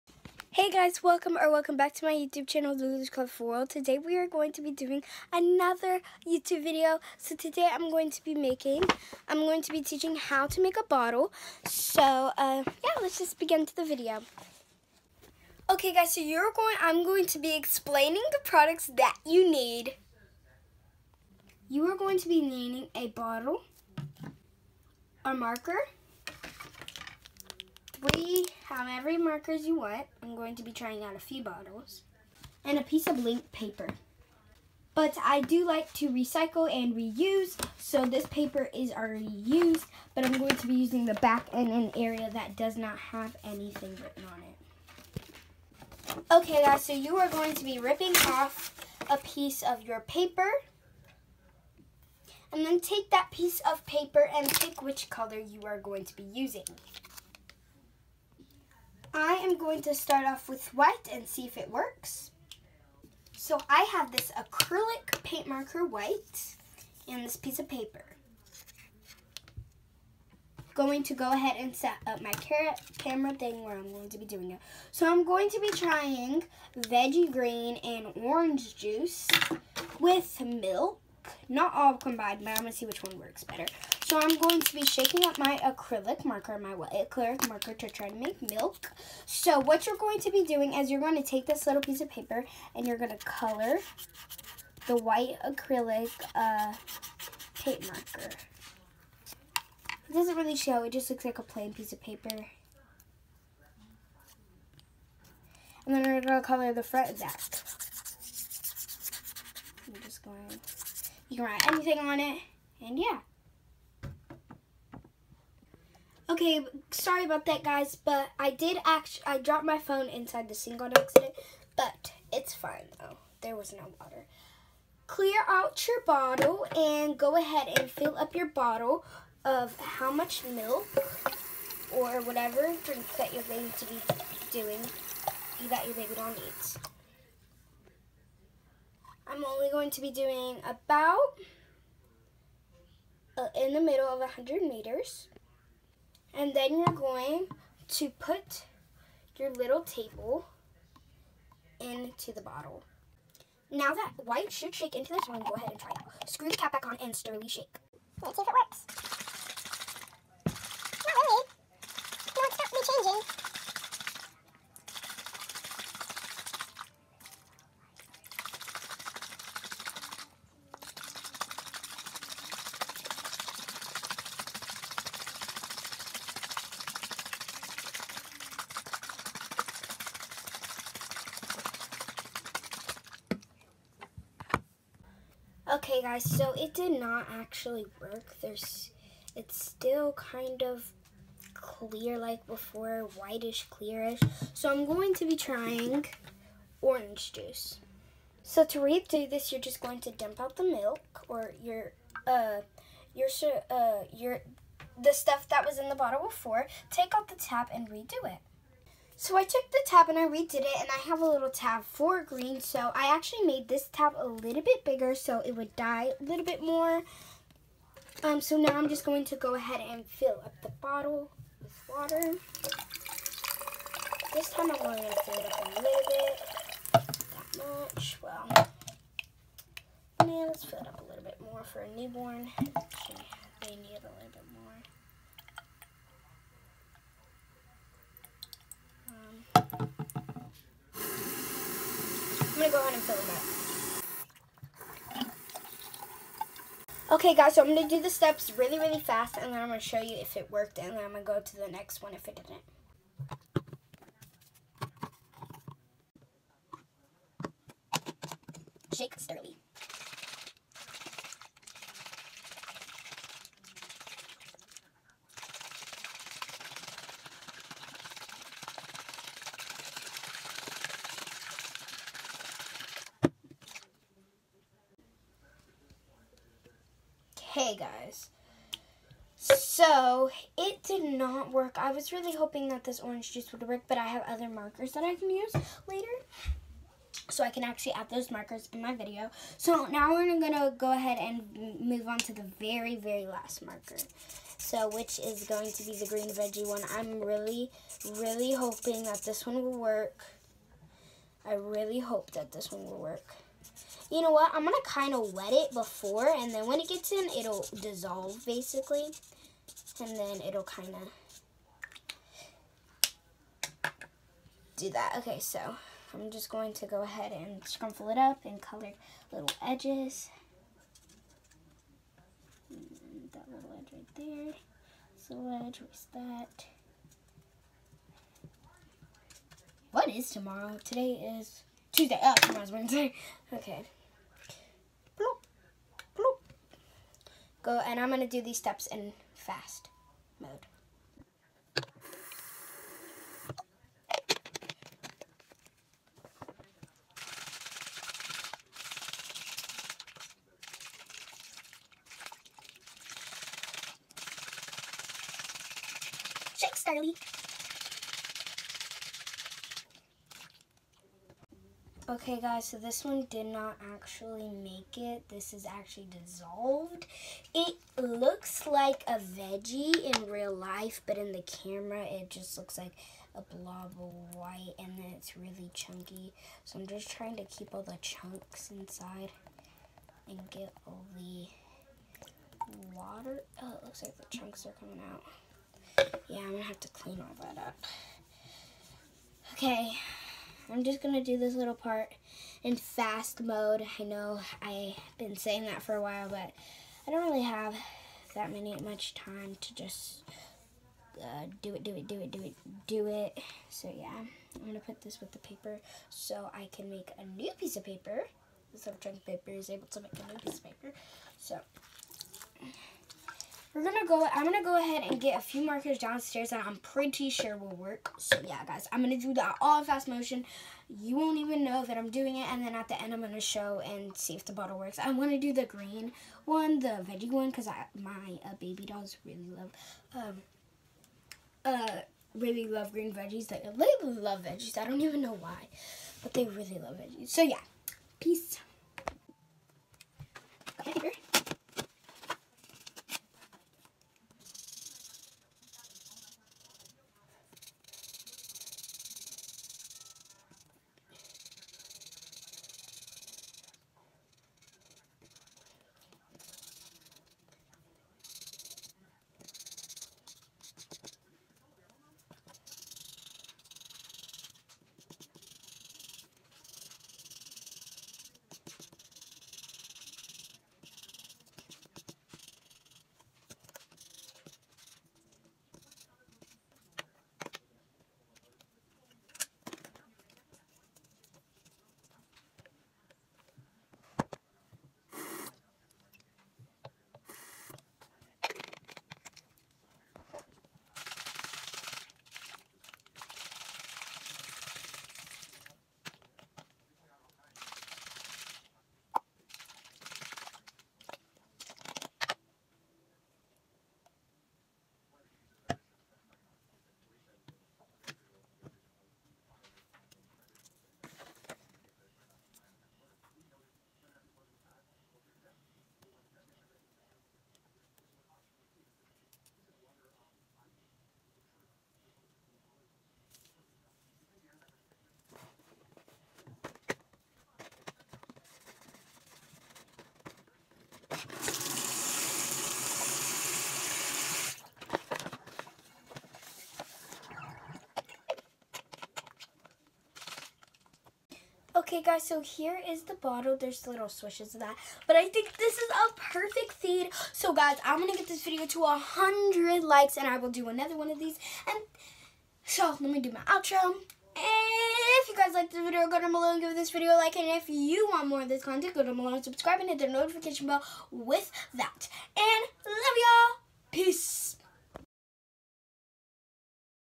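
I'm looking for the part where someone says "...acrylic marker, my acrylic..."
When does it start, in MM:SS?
01:25.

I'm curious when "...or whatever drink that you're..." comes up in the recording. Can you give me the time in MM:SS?
02:11.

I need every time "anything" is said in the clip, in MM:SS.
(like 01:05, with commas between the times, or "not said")
00:43, 01:51.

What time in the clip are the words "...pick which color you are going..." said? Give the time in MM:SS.
00:54.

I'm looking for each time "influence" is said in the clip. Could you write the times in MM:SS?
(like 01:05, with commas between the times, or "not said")
not said.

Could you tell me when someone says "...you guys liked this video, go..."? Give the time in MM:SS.
09:15.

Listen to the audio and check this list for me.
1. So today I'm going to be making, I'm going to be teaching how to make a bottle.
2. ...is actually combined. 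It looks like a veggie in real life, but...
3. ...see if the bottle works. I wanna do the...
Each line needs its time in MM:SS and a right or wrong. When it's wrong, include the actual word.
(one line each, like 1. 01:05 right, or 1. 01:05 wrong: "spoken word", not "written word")
1. 00:07 right
2. 06:05 wrong: "dissolved", not "combined"
3. 07:04 right.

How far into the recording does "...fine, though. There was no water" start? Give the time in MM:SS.
02:02.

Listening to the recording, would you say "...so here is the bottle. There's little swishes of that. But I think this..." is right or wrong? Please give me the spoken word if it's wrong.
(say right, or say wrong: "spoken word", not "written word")
right.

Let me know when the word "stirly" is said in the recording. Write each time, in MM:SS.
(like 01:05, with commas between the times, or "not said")
02:37, 04:19.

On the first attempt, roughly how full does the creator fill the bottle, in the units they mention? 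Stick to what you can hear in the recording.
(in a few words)
Middle of 100.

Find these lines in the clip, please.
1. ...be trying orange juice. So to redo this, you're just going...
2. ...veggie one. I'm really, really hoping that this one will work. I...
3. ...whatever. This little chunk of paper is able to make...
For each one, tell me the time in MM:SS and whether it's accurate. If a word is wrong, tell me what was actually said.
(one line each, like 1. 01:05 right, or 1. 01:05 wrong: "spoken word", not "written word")
1. 03:15 right
2. 04:56 right
3. 06:47 wrong: "paper", not "whatever".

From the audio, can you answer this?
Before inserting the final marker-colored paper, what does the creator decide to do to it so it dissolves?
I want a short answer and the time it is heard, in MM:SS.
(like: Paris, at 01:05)
Wet it, at 05:04.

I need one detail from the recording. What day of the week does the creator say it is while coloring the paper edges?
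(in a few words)
Tuesday.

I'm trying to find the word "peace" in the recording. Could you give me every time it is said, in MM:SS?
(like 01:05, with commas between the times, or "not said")
07:18, 09:23.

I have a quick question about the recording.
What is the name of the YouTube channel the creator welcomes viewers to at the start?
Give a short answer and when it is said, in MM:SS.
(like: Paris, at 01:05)
The LuLu's Colorful World, at 00:02.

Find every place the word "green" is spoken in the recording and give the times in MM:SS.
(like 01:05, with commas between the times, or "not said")
01:17, 03:32, 04:56, 07:05, 07:12.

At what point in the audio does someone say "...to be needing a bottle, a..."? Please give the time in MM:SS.
00:22.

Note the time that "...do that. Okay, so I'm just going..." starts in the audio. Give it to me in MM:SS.
05:14.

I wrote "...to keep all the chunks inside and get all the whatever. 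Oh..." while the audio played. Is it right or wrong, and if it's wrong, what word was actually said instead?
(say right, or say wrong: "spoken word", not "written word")
wrong: "water", not "whatever".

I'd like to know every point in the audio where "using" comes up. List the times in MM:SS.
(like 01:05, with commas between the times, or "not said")
00:40, 00:56.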